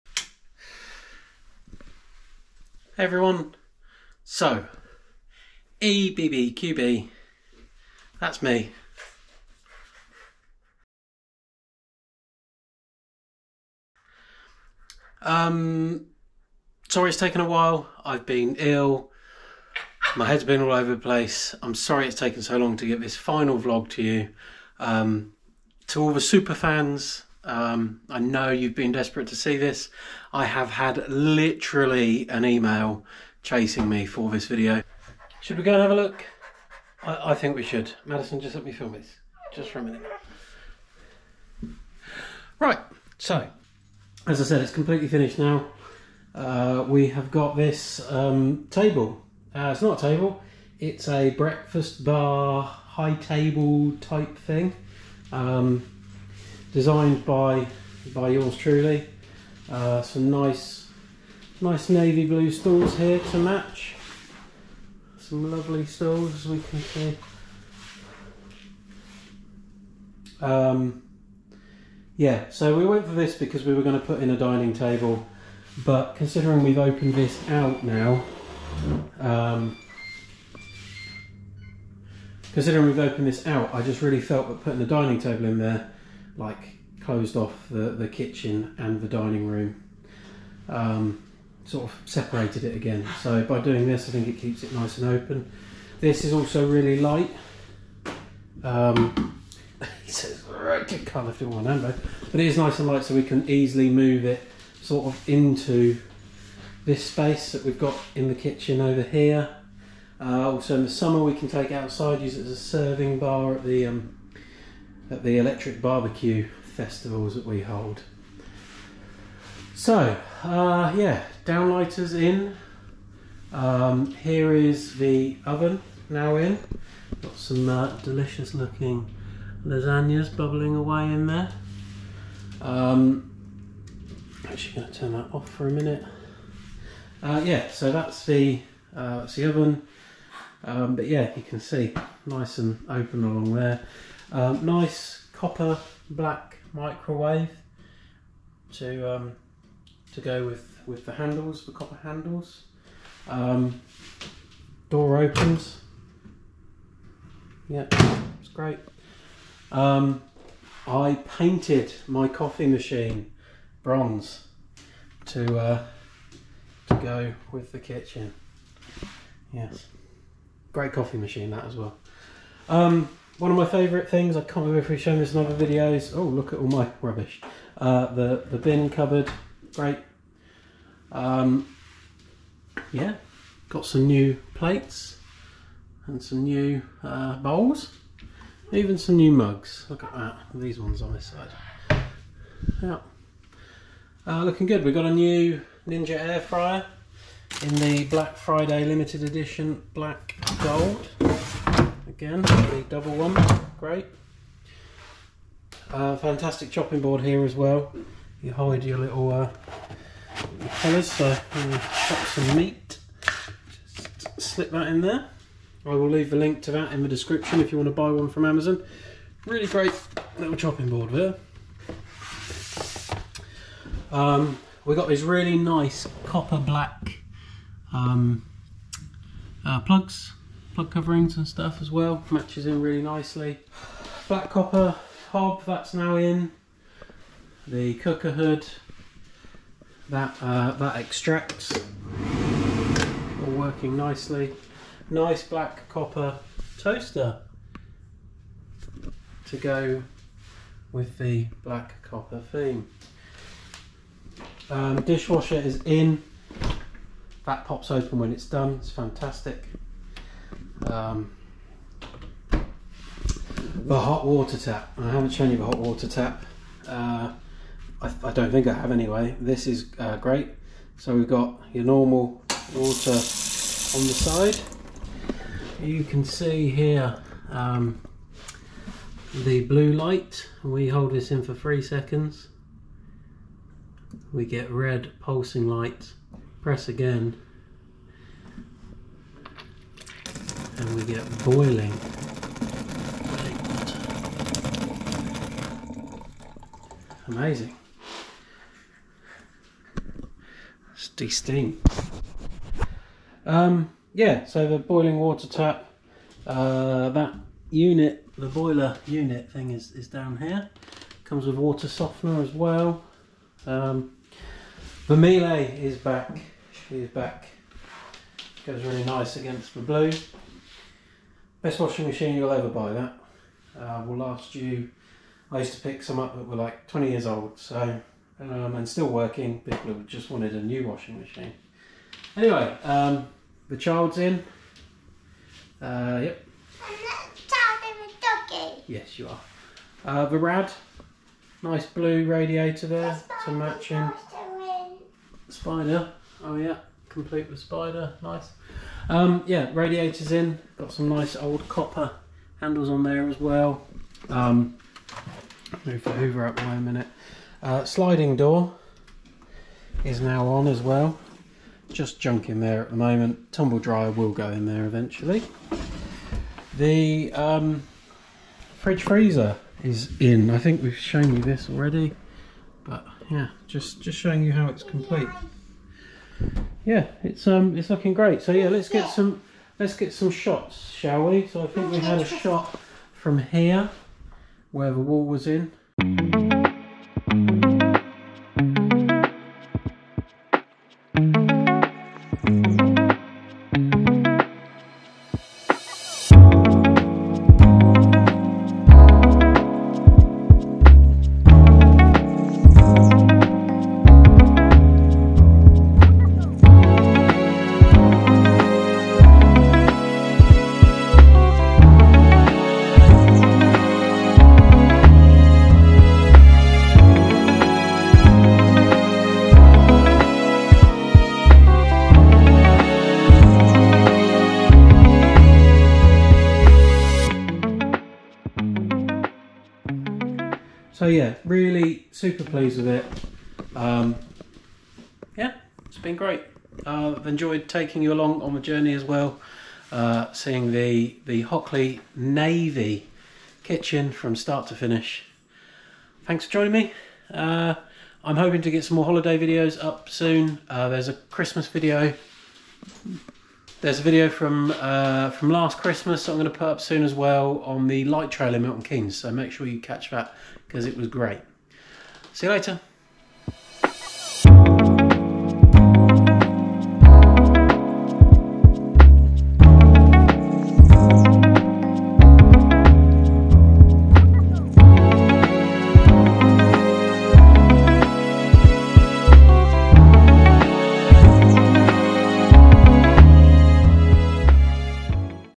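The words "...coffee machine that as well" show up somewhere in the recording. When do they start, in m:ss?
2:50.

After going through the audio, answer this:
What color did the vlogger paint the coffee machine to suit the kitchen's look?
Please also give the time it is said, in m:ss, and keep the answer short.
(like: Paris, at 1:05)
bronze, at 2:43.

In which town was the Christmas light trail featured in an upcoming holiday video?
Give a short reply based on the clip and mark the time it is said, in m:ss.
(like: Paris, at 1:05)
Milton Keynes, at 7:38.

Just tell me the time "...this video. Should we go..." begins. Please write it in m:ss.
0:34.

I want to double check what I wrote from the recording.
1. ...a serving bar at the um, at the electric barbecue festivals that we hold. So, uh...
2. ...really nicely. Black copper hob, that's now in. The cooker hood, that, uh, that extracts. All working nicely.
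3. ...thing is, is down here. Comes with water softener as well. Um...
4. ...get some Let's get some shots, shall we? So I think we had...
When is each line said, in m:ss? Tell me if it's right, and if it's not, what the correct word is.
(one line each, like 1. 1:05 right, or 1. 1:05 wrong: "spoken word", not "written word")
1. 1:52 right
2. 3:52 right
3. 5:09 right
4. 6:18 right.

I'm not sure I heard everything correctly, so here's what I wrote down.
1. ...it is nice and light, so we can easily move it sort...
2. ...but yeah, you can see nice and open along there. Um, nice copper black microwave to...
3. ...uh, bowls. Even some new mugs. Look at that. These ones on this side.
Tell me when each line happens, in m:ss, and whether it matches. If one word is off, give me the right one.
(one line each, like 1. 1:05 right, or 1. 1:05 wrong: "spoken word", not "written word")
1. 1:42 right
2. 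2:20 right
3. 3:07 right.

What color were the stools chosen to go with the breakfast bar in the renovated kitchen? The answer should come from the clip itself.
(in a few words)
navy blue.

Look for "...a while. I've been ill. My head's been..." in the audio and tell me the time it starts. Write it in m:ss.
0:17.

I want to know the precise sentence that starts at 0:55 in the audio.
Um, designed by by yours truly.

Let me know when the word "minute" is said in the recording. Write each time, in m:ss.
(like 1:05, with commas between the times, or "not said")
0:39, 2:15, 5:56.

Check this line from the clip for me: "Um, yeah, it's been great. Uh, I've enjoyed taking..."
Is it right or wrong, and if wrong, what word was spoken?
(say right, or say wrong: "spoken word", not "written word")
right.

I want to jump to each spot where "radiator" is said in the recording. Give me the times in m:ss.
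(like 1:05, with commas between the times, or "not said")
5:42, 5:49.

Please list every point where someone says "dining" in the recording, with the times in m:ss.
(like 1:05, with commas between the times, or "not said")
1:14, 1:24, 1:29.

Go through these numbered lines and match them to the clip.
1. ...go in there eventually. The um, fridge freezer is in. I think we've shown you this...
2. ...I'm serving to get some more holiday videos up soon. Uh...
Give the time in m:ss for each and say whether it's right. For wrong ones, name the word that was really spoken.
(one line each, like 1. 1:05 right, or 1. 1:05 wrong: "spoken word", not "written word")
1. 6:04 right
2. 7:28 wrong: "hoping", not "serving".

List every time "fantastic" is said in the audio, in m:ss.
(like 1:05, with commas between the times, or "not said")
3:26, 4:18.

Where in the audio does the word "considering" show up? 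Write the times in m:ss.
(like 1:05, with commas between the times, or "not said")
1:16, 1:22.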